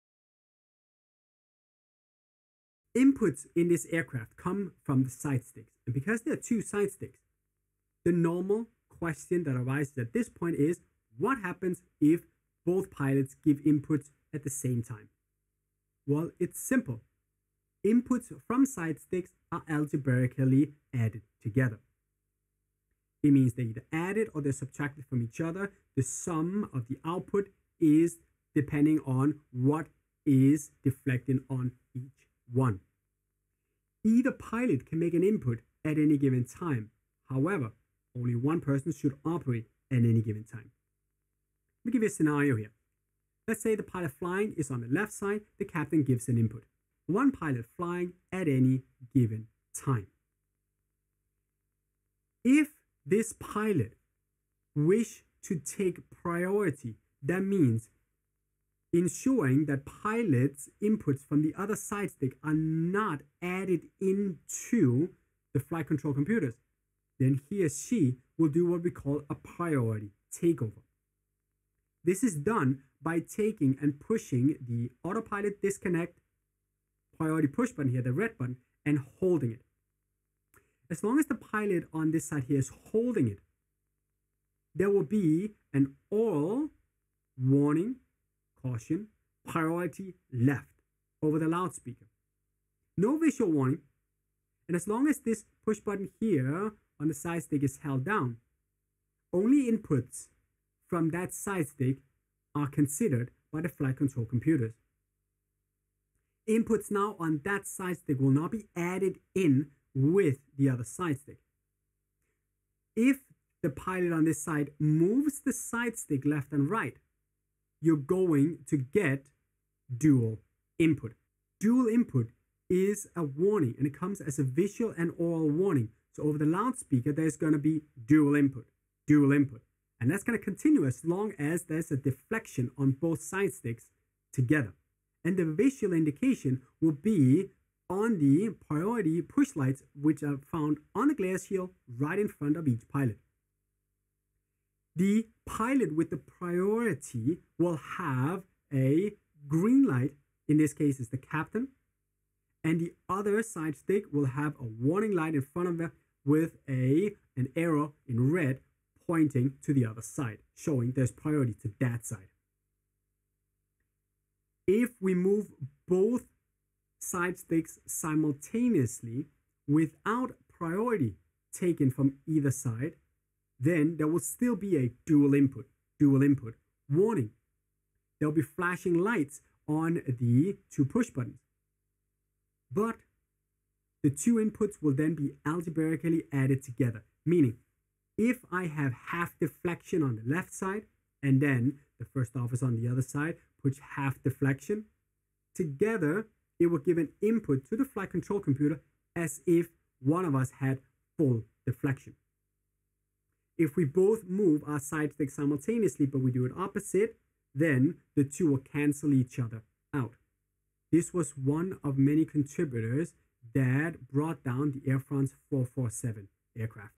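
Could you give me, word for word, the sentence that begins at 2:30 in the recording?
In this case, is the captain.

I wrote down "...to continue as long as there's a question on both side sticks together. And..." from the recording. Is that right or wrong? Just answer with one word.
wrong.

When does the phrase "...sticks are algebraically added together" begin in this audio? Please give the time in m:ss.
0:18.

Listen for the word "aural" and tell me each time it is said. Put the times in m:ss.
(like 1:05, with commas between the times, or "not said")
1:26, 2:05.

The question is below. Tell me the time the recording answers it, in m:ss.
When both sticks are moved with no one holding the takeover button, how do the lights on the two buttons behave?
2:58.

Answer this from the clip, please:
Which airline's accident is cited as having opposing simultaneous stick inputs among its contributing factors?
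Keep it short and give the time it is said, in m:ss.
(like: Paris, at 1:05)
Air France 447, at 3:34.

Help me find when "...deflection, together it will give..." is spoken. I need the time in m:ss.
3:14.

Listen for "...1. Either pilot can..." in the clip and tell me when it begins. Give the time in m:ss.
0:32.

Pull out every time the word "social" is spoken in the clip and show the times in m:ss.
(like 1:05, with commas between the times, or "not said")
not said.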